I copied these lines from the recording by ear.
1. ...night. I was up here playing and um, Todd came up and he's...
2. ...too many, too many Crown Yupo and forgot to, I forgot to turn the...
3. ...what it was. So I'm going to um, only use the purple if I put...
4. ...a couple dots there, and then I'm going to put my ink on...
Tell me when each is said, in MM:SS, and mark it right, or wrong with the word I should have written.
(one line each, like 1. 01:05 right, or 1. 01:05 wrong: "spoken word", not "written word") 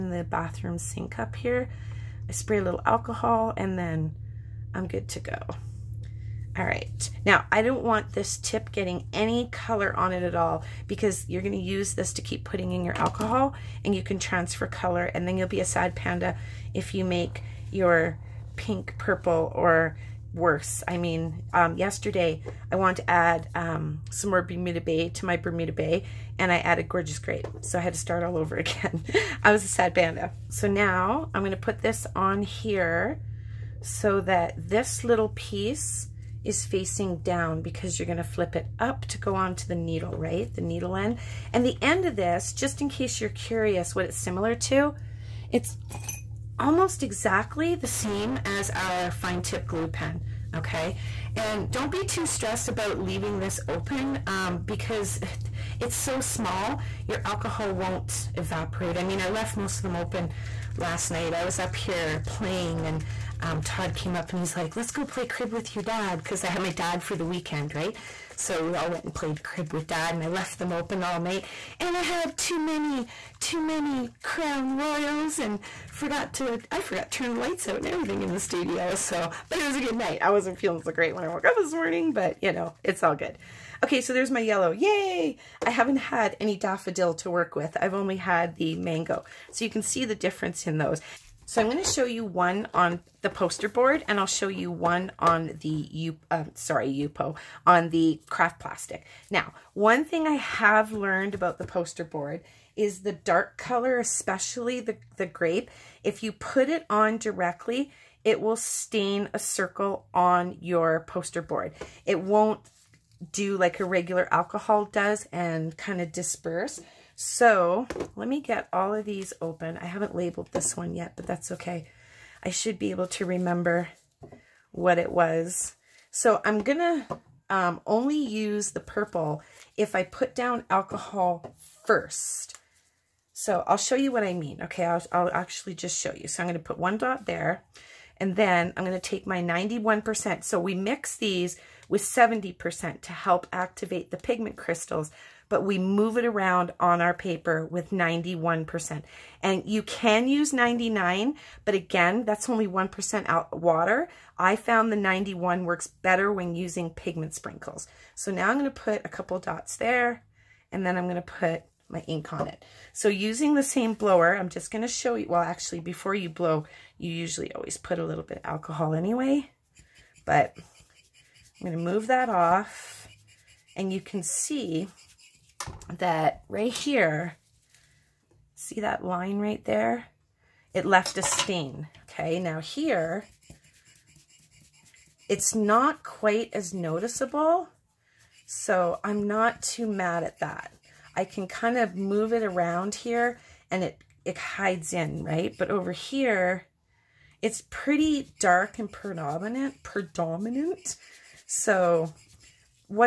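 1. 01:01 right
2. 01:12 wrong: "Royals", not "Yupo"
3. 02:04 right
4. 02:39 right.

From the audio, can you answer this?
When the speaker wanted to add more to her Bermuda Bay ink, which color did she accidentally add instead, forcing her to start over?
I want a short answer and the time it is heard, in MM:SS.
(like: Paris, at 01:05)
Gorgeous Grape, at 00:26.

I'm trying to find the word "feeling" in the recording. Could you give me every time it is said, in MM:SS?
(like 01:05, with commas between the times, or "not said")
01:20.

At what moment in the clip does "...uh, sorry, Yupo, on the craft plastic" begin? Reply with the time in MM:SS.
01:36.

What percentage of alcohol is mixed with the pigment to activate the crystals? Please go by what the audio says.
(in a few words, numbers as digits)
70%.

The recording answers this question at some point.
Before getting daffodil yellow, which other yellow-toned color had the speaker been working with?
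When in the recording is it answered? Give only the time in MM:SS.
01:28.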